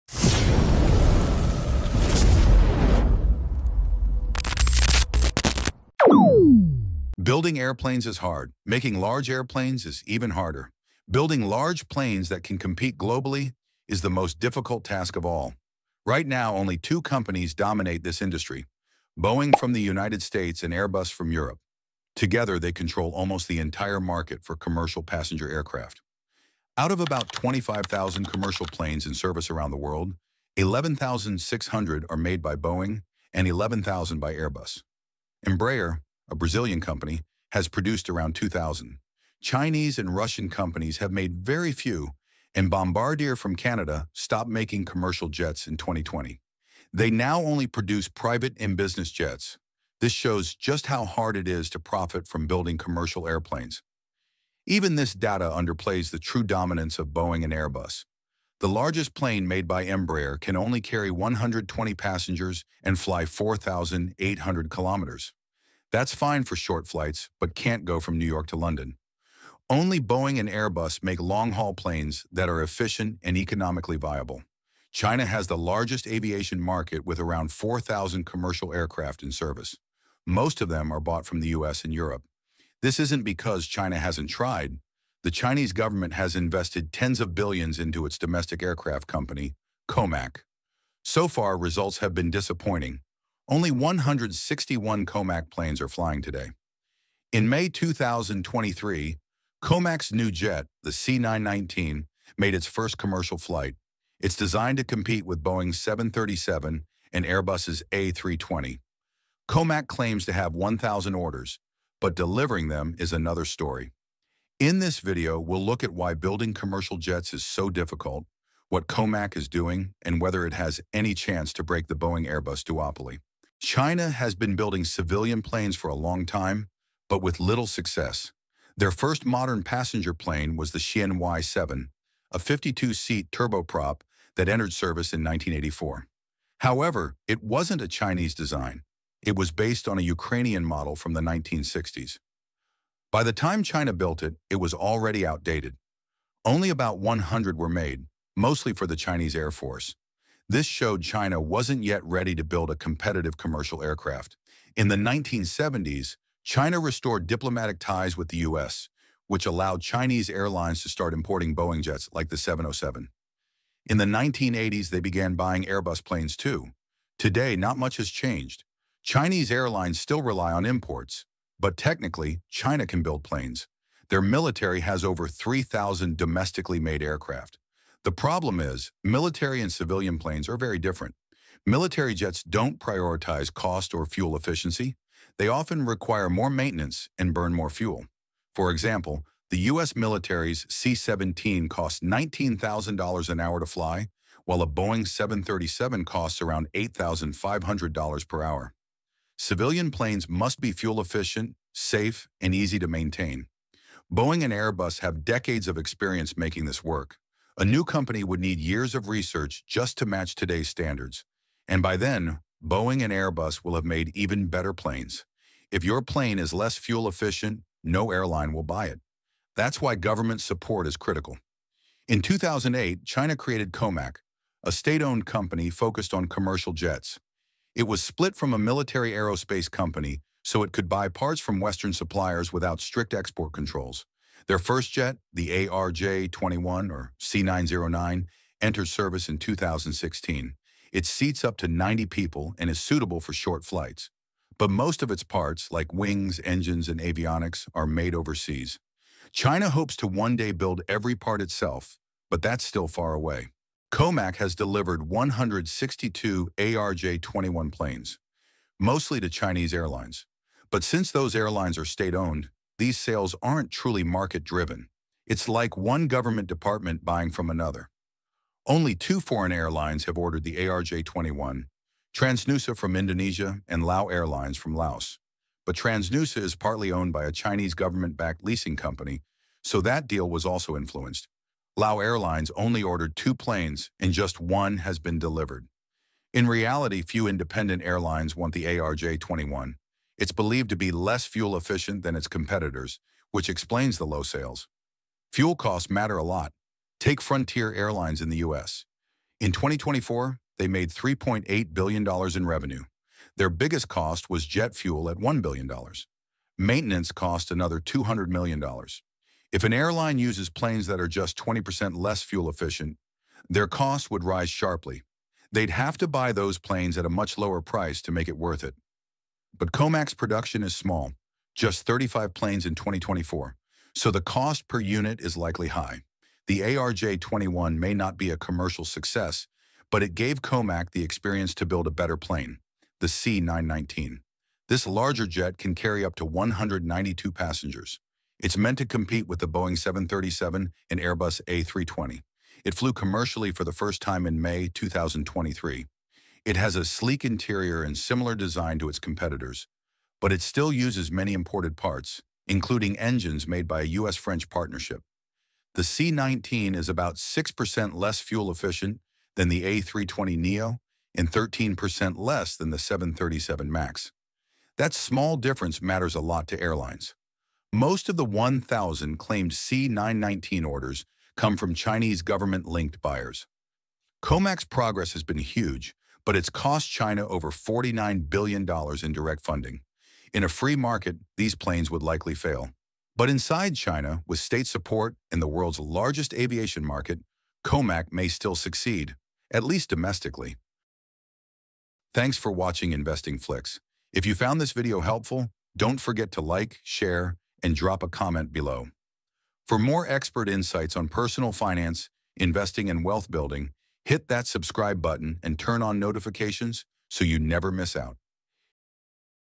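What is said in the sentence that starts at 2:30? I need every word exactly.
This showed China wasn't yet ready to build a competitive commercial aircraft.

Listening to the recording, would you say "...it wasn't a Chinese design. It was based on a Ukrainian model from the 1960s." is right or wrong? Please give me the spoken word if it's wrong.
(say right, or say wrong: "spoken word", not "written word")
right.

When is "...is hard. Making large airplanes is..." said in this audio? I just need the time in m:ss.
0:08.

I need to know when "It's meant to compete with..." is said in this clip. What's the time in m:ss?
5:38.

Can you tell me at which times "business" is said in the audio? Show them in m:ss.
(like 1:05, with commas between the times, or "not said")
0:48.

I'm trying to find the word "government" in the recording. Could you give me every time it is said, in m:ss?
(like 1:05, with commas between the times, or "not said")
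1:25, 3:39, 4:26, 4:37, 6:12.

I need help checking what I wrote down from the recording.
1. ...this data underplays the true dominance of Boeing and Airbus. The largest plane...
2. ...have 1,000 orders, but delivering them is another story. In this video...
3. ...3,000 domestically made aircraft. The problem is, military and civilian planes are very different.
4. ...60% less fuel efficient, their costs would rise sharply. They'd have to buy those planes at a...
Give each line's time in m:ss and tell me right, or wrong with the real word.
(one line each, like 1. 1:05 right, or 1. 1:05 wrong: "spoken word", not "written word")
1. 0:54 right
2. 1:50 right
3. 2:55 right
4. 5:11 wrong: "20", not "60".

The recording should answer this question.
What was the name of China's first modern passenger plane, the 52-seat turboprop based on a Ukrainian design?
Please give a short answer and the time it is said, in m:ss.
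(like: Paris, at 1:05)
Xian Y-7, at 2:10.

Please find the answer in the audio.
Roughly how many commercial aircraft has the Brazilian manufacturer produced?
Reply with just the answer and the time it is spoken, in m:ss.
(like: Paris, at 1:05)
around 2,000, at 0:38.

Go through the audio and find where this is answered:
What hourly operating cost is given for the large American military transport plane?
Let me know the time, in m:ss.
3:11.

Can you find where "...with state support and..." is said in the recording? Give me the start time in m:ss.
6:24.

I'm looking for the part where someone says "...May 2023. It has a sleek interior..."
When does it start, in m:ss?
5:44.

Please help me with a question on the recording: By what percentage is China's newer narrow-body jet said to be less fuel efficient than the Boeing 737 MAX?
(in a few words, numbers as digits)
13%.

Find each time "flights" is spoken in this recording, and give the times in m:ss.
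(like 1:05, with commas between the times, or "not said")
1:06, 1:43, 4:03.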